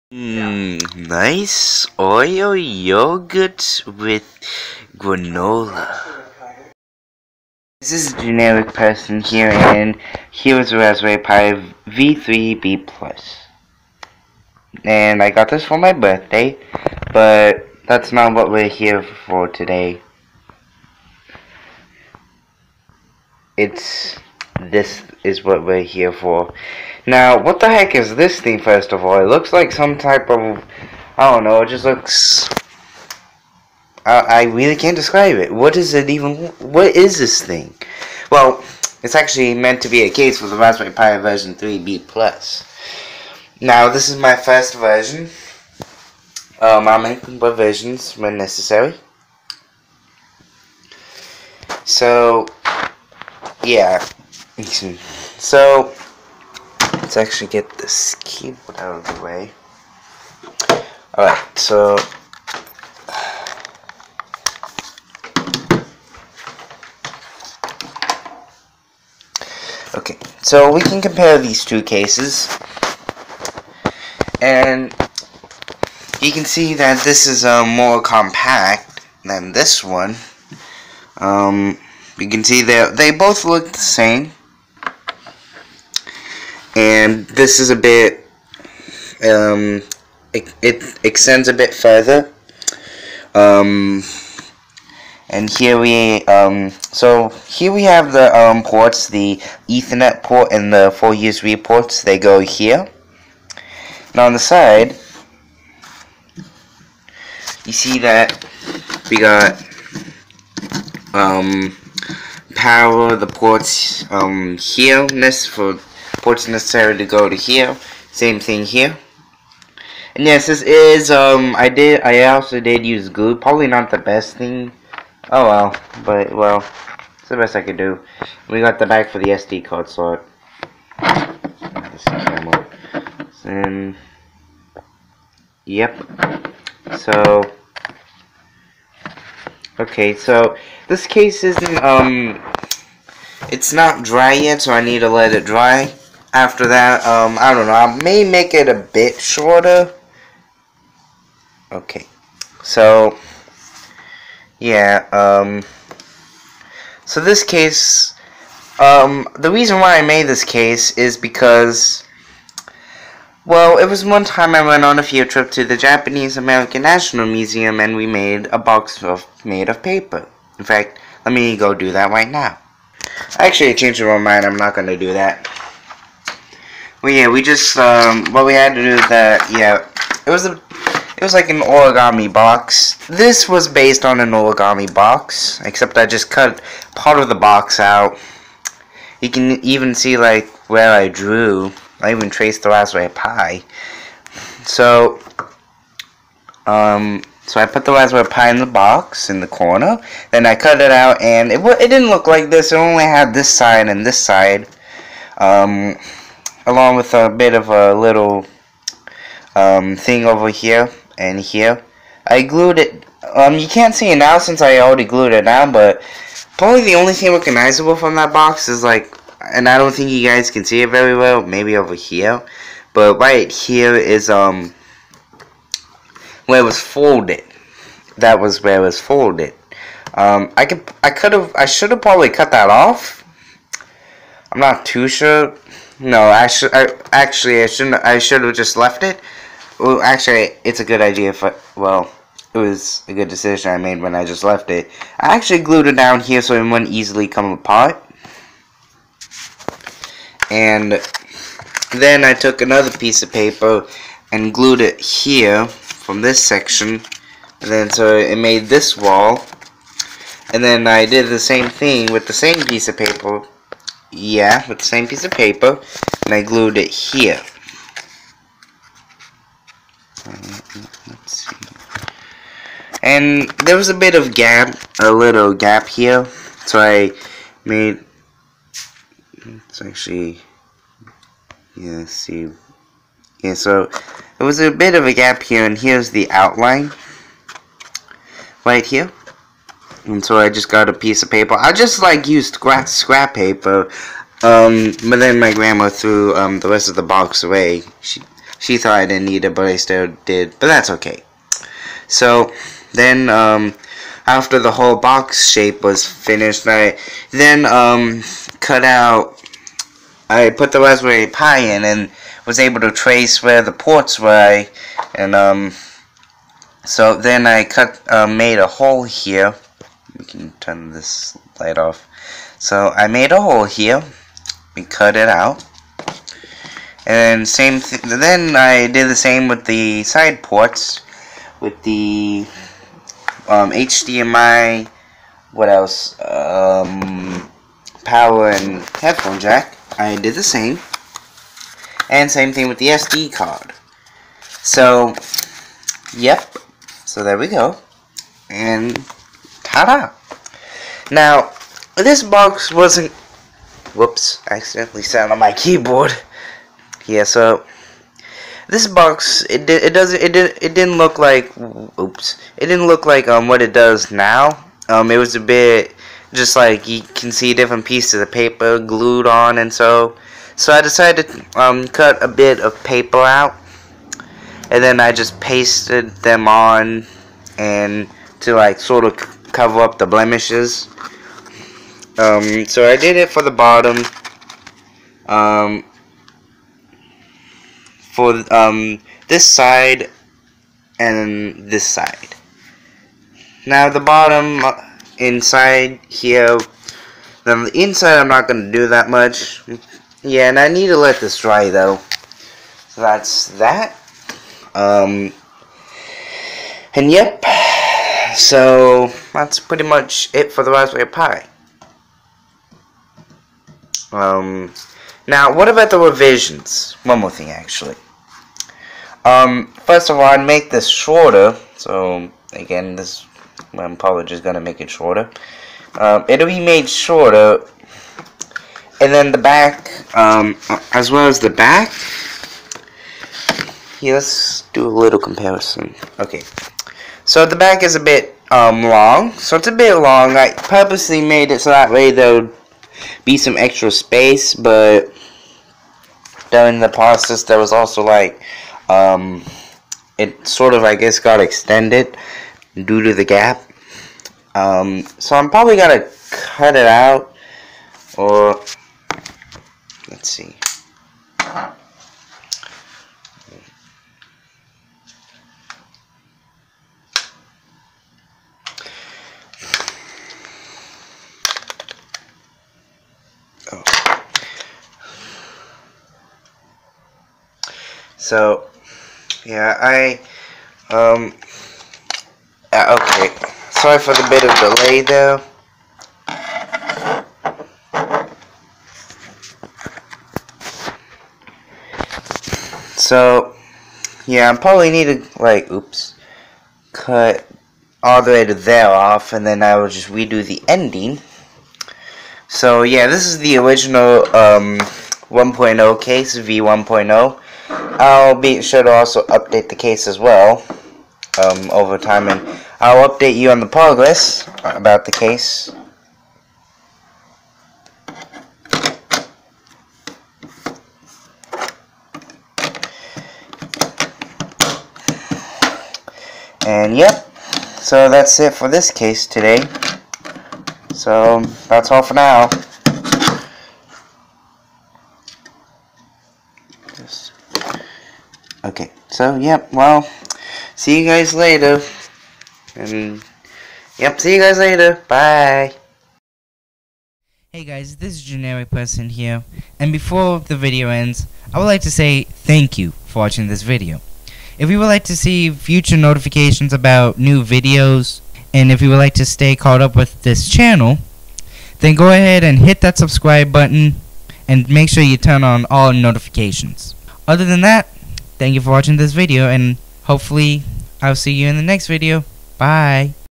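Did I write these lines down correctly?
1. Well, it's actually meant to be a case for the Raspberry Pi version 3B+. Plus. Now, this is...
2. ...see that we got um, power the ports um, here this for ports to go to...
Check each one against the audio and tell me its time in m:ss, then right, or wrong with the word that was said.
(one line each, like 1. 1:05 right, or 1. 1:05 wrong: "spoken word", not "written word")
1. 0:38 right
2. 1:47 right.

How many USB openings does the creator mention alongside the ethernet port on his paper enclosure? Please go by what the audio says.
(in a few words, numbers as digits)
4.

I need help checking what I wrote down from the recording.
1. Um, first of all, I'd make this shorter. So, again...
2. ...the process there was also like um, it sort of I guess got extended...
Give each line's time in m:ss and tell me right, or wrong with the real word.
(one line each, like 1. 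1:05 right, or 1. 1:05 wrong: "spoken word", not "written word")
1. 6:59 right
2. 7:26 right.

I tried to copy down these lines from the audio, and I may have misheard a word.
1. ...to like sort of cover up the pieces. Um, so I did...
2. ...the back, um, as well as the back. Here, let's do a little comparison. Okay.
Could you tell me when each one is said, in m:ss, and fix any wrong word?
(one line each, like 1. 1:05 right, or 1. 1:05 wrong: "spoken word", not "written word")
1. 6:18 wrong: "blemishes", not "pieces"
2. 7:09 right.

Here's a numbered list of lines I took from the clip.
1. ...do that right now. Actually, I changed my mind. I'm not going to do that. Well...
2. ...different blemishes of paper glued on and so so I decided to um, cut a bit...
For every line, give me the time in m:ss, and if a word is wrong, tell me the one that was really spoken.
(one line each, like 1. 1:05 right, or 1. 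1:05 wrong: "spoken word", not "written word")
1. 2:51 right
2. 6:07 wrong: "pieces", not "blemishes".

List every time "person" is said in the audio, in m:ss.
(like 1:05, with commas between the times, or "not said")
0:08, 9:08.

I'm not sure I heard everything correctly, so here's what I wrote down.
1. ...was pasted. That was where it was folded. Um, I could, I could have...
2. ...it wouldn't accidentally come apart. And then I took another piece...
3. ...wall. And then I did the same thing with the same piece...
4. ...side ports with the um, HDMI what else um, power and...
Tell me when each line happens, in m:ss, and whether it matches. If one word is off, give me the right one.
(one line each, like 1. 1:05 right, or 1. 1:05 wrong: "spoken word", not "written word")
1. 3:46 wrong: "folded", not "pasted"
2. 4:06 wrong: "easily", not "accidentally"
3. 4:18 right
4. 5:30 right.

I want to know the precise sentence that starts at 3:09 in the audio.
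You can even see, like, where I drew.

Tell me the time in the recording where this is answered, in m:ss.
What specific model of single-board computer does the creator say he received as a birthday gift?
0:10.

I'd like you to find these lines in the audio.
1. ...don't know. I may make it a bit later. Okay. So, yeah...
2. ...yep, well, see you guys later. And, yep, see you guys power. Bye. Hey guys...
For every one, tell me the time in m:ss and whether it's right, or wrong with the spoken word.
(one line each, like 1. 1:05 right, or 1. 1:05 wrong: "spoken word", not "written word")
1. 2:27 wrong: "shorter", not "later"
2. 8:59 wrong: "later", not "power".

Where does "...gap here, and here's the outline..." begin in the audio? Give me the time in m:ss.
4:45.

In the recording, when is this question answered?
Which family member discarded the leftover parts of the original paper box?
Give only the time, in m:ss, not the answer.
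4:55.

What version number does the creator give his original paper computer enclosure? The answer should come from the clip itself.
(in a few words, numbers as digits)
V1.0.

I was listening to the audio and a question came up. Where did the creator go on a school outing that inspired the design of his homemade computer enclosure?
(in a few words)
Japanese American National Museum.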